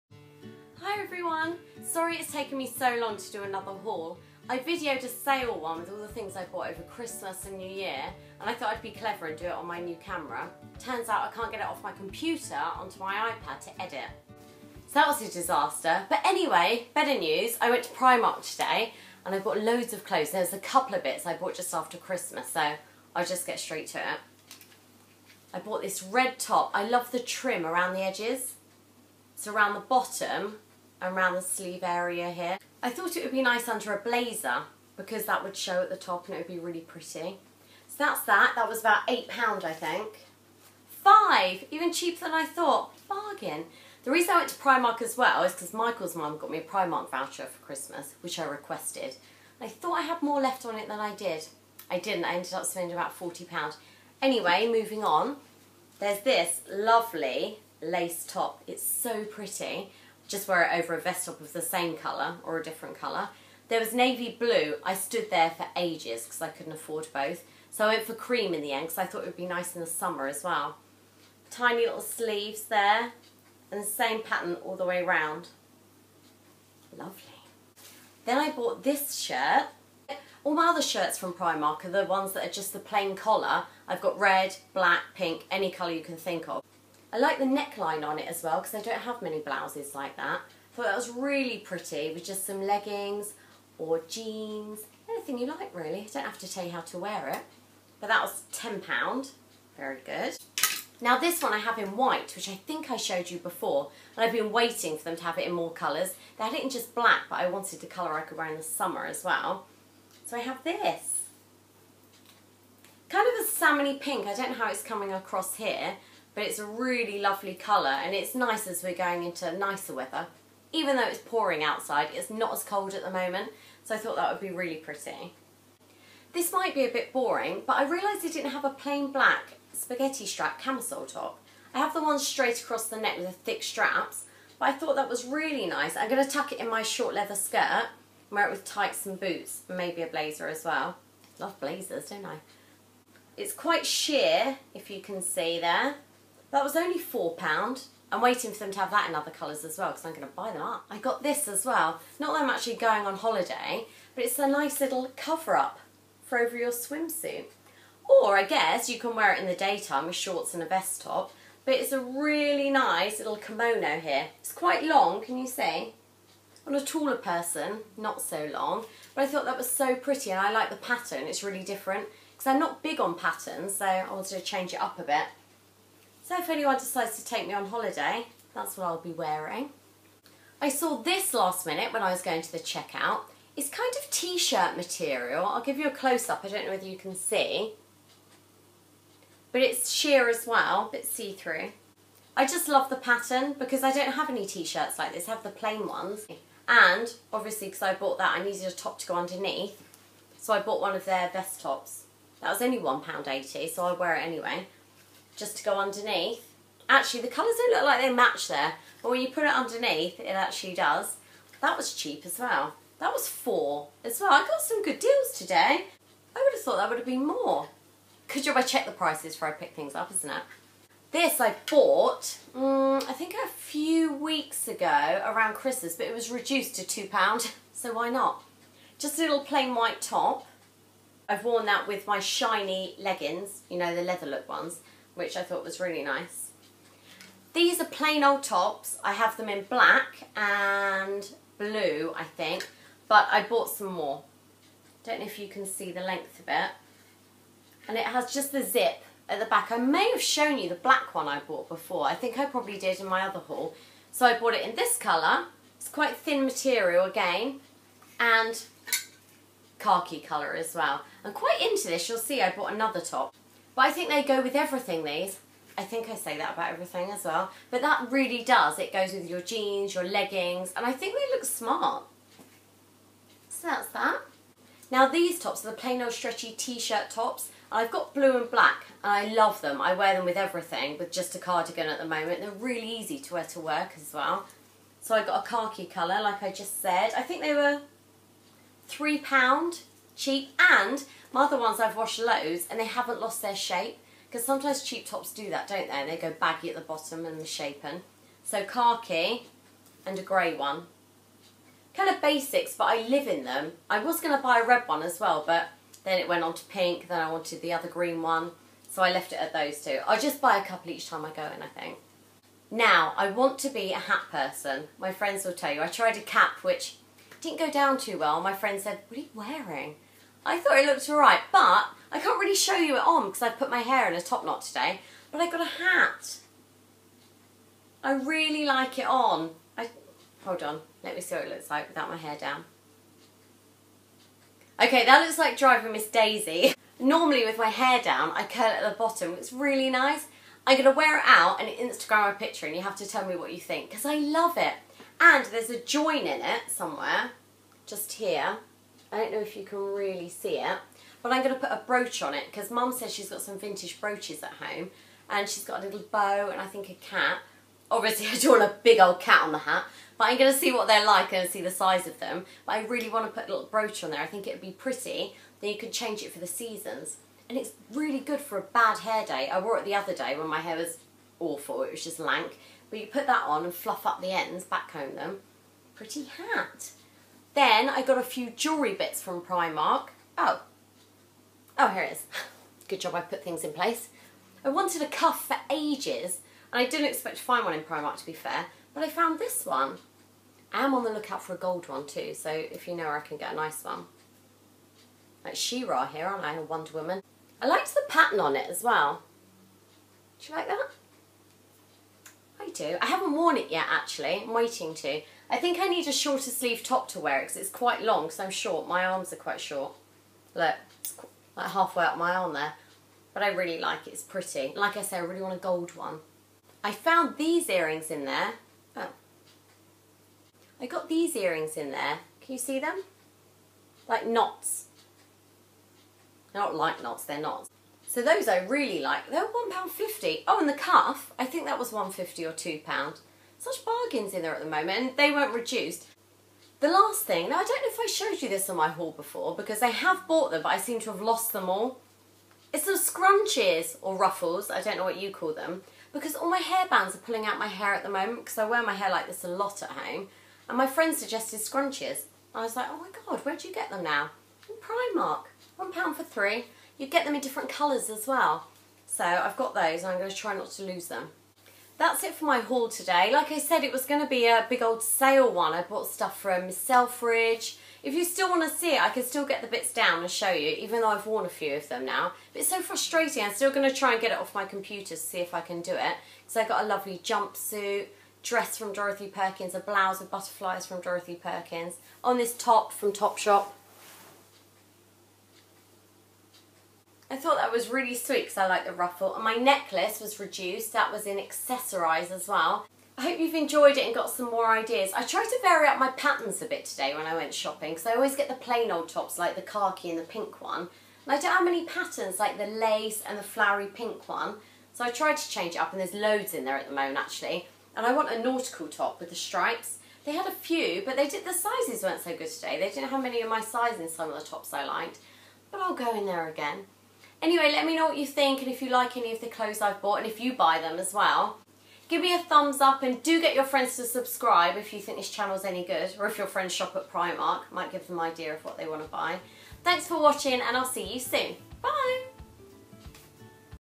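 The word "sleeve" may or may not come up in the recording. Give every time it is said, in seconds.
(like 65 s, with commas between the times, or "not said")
31 s, 72 s, 406 s.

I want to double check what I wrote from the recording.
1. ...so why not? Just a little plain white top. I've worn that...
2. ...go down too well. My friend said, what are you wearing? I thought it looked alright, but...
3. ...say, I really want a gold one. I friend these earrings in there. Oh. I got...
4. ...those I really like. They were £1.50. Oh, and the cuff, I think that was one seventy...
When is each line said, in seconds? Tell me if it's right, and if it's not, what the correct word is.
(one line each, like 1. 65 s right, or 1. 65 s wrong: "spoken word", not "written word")
1. 227 s right
2. 317 s right
3. 415 s wrong: "found", not "friend"
4. 428 s wrong: "fifty", not "seventy".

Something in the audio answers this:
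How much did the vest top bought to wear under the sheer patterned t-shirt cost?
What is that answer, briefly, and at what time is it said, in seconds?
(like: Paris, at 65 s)
£1.80, at 202 s.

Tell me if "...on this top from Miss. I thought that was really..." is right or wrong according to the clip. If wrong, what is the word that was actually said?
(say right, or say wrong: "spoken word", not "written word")
wrong: "Topshop", not "Miss".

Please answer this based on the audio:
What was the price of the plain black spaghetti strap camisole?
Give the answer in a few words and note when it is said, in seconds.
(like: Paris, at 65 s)
£4, at 146 s.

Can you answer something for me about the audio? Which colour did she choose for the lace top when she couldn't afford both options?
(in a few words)
Cream.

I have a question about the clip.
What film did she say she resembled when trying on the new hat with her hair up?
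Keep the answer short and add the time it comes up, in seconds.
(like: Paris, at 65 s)
Driving Miss Daisy, at 335 s.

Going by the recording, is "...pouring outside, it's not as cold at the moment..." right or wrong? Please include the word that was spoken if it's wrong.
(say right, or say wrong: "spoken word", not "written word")
right.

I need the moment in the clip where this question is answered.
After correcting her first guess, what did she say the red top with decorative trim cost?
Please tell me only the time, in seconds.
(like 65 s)
40 s.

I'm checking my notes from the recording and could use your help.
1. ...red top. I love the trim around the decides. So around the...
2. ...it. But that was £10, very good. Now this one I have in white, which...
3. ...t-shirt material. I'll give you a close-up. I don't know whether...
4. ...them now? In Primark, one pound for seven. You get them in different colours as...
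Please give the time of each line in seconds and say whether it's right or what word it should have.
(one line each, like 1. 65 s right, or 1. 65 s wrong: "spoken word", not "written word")
1. 26 s wrong: "edges", not "decides"
2. 97 s right
3. 184 s right
4. 453 s wrong: "three", not "seven".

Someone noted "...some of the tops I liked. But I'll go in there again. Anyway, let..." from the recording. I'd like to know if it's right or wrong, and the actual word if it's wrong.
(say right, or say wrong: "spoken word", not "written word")
right.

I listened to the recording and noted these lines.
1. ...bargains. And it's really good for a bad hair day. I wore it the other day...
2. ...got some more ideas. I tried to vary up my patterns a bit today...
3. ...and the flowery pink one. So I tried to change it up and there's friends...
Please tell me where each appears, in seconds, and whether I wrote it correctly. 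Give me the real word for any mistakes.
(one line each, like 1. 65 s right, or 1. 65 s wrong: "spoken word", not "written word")
1. 366 s wrong: "seasons", not "bargains"
2. 494 s right
3. 503 s wrong: "loads", not "friends".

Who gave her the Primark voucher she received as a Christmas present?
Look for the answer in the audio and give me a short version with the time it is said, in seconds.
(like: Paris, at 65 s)
Michael's mum, at 45 s.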